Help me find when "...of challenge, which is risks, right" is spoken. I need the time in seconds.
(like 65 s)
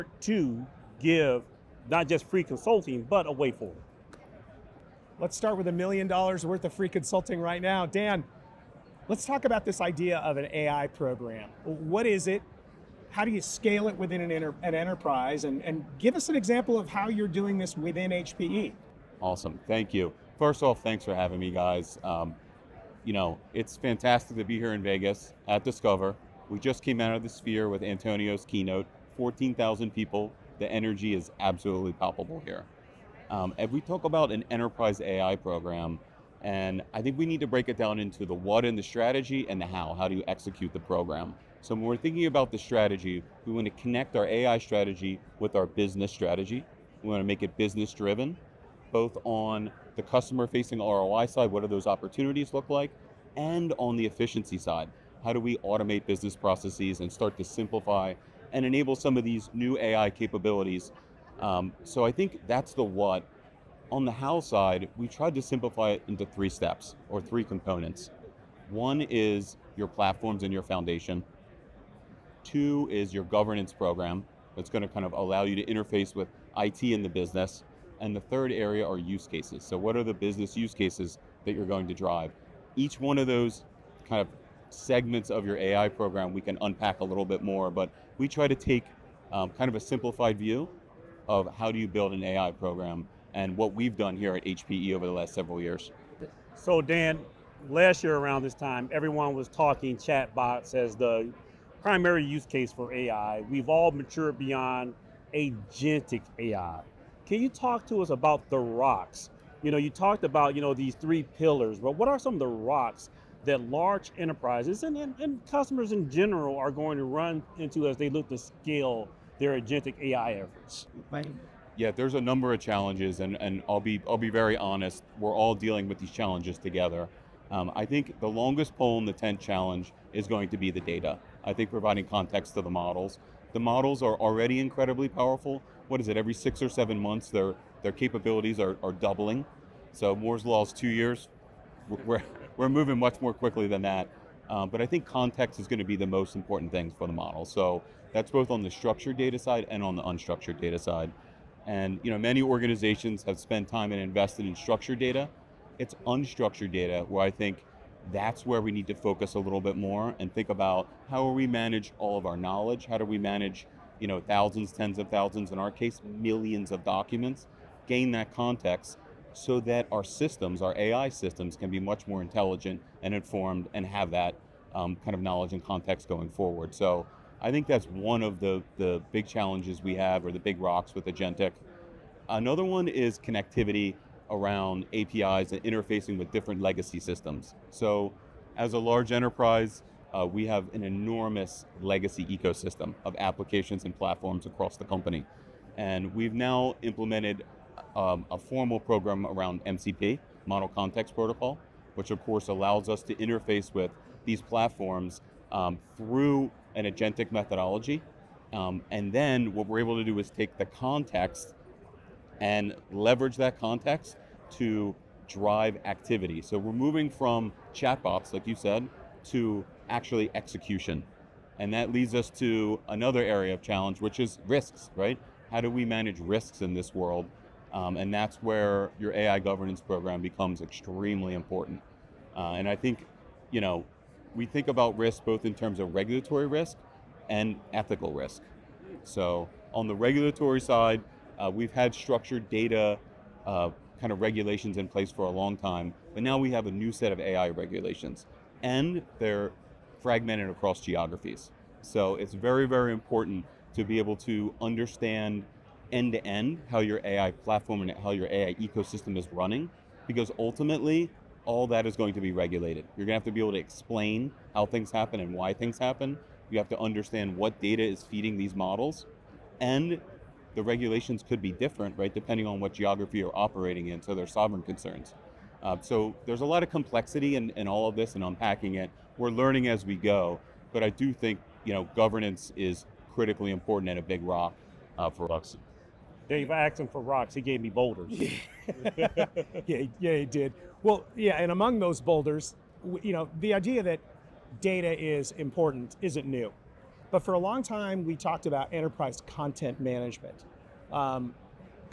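223 s.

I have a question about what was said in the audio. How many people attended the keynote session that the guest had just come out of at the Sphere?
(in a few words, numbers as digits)
14,000.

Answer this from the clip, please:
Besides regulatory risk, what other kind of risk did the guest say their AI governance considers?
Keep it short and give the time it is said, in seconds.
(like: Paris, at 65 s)
Ethical risk, at 237 s.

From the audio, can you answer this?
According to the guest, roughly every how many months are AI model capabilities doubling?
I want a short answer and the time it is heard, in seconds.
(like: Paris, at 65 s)
6 or 7 months, at 136 s.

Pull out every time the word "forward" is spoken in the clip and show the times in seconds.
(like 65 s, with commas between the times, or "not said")
3 s, 176 s.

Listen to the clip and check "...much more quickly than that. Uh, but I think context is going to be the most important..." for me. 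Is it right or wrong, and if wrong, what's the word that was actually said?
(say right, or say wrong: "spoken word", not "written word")
right.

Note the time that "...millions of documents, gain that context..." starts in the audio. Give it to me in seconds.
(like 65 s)
166 s.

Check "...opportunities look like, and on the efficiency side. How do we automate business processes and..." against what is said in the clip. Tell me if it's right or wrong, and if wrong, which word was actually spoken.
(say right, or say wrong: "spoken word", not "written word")
right.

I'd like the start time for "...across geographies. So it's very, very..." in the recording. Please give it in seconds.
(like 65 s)
250 s.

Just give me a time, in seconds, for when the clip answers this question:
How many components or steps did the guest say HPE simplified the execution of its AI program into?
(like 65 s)
66 s.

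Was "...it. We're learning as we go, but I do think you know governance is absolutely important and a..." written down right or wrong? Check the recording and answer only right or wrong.
wrong.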